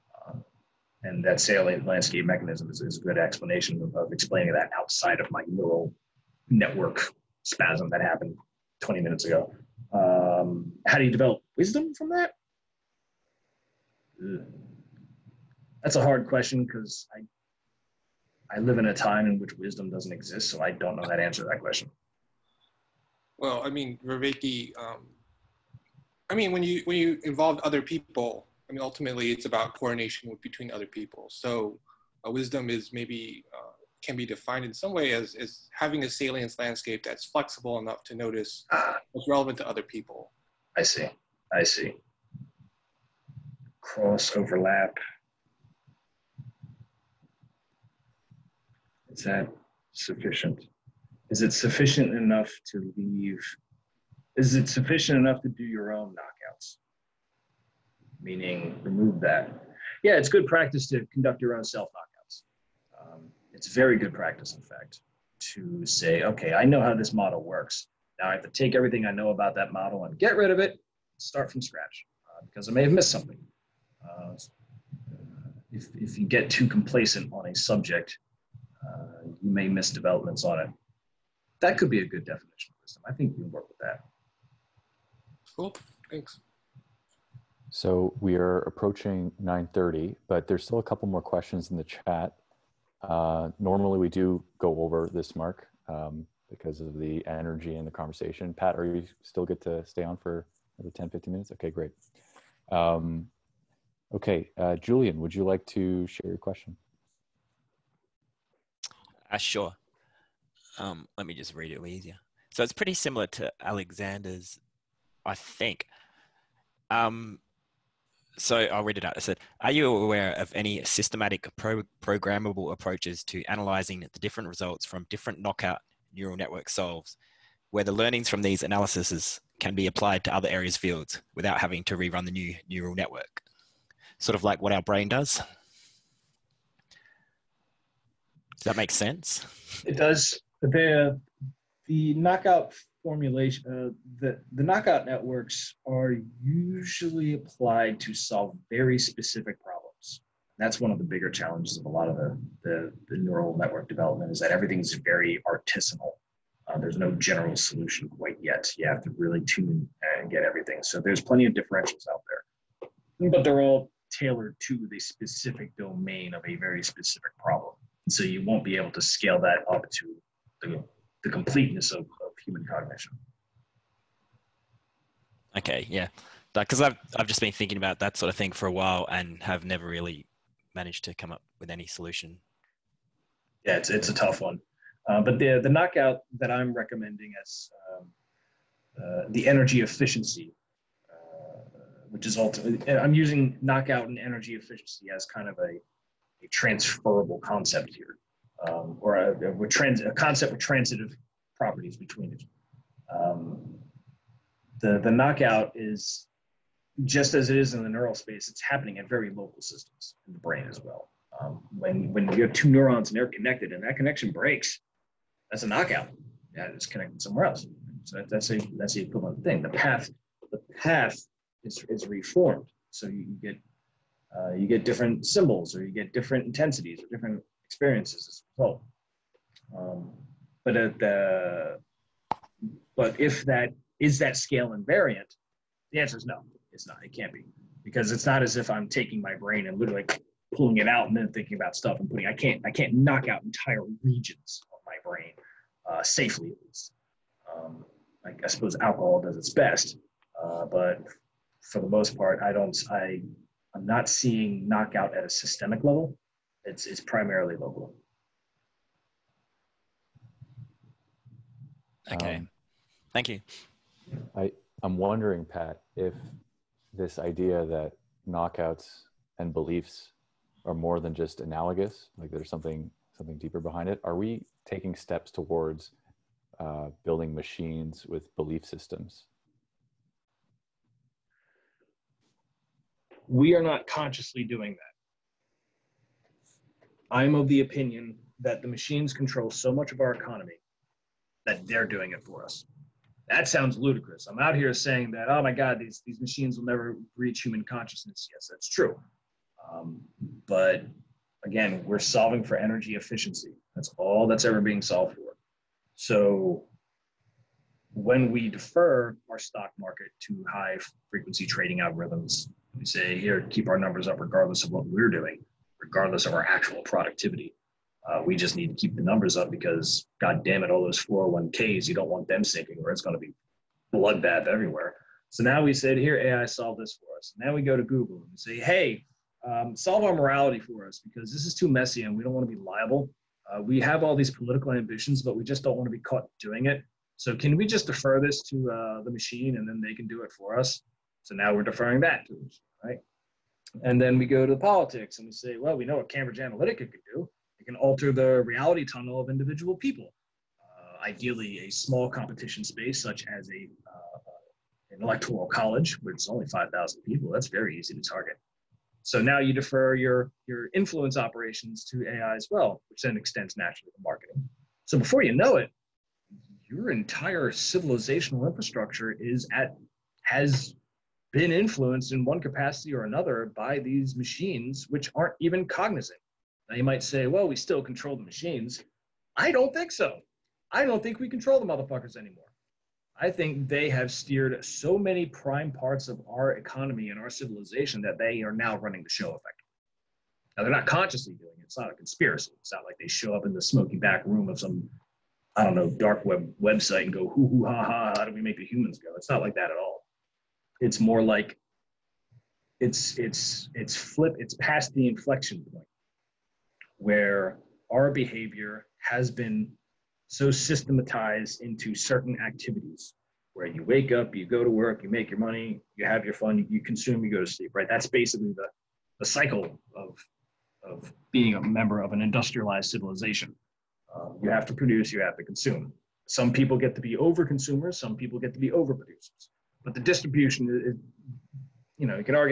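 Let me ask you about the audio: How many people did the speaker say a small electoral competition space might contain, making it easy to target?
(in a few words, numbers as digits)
5,000.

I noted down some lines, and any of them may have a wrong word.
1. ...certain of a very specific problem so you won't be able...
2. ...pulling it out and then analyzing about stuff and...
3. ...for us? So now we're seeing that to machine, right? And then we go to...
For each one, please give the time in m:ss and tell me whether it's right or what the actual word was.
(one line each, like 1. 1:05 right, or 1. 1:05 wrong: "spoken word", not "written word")
1. 2:45 wrong: "domain", not "certain"
2. 4:00 wrong: "thinking", not "analyzing"
3. 5:40 wrong: "deferring", not "seeing".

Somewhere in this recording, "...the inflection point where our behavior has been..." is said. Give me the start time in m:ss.
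6:44.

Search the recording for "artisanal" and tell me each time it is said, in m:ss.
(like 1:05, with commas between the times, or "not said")
2:35.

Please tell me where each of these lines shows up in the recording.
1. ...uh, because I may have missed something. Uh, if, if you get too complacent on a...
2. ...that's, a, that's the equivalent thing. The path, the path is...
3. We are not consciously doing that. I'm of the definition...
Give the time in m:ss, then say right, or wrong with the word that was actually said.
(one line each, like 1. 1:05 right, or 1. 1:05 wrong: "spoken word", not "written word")
1. 1:12 right
2. 3:38 right
3. 4:43 wrong: "opinion", not "definition".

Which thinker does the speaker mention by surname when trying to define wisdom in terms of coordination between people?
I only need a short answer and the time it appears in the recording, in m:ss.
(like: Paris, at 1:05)
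Vervaeke, at 0:24.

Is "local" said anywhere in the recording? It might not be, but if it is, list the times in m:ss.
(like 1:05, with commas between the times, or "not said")
3:29, 4:17.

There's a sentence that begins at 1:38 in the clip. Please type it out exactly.
Pat, are you still good to stay on for the 10, 15 minutes?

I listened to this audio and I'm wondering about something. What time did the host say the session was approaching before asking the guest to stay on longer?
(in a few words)
9:30.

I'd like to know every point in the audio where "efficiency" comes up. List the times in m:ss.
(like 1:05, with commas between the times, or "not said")
3:09, 3:14, 5:02.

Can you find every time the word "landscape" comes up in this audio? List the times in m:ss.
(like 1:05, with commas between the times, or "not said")
0:01, 0:36.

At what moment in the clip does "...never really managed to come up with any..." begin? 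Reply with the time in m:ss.
2:59.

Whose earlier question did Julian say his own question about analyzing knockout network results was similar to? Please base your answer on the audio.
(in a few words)
Alexander.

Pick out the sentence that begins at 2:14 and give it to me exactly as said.
Sort of like what our brain does.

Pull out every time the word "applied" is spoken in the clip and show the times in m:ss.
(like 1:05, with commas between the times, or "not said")
2:09, 2:27.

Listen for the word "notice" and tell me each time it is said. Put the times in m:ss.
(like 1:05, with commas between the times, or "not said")
0:38.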